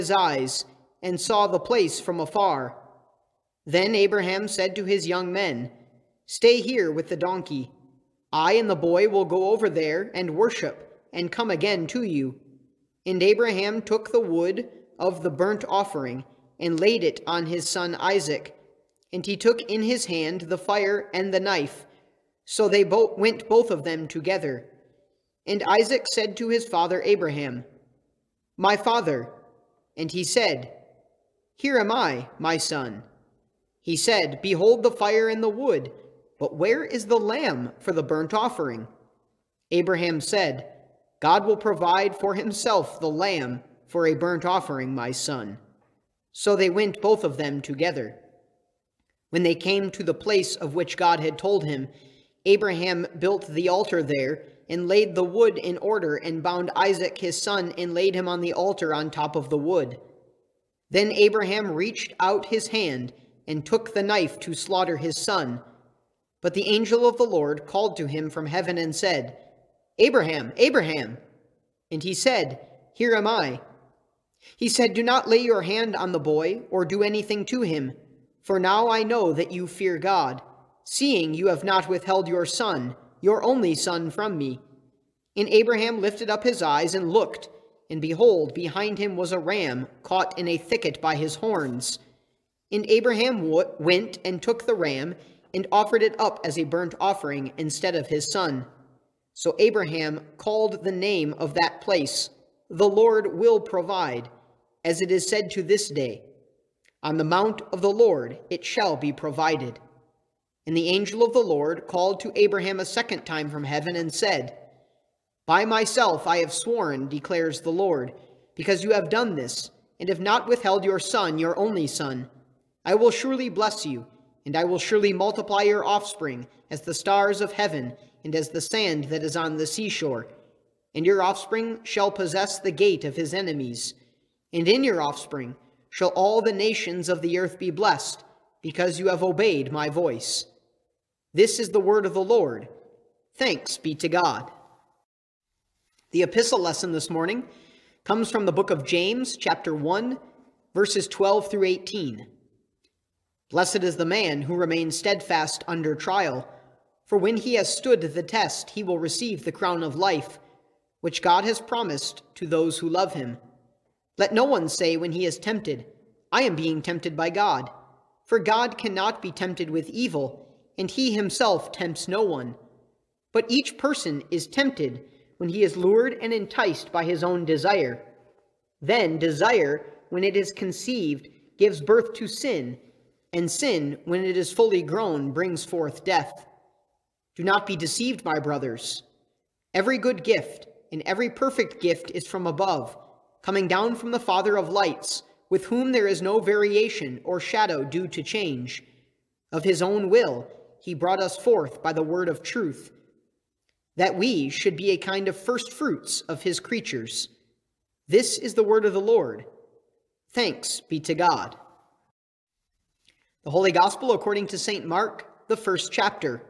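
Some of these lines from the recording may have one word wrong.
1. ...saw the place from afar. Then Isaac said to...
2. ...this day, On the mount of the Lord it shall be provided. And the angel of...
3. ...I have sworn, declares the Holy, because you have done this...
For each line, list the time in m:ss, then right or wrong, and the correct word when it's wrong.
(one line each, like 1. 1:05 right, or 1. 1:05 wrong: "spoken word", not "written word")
1. 0:01 wrong: "Abraham", not "Isaac"
2. 1:45 right
3. 1:56 wrong: "Lord", not "Holy".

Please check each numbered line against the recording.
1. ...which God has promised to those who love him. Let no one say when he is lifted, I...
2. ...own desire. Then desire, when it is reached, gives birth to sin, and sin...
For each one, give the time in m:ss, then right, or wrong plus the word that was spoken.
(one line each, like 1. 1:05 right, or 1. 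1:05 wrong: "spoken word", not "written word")
1. 2:41 wrong: "tempted", not "lifted"
2. 2:57 wrong: "conceived", not "reached".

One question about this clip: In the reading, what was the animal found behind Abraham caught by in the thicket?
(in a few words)
his horns.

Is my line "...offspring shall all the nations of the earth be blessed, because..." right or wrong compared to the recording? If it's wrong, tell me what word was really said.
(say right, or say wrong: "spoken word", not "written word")
right.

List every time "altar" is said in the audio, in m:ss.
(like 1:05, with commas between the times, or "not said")
0:53, 0:58.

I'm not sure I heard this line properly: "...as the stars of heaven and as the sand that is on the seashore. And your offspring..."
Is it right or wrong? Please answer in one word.
right.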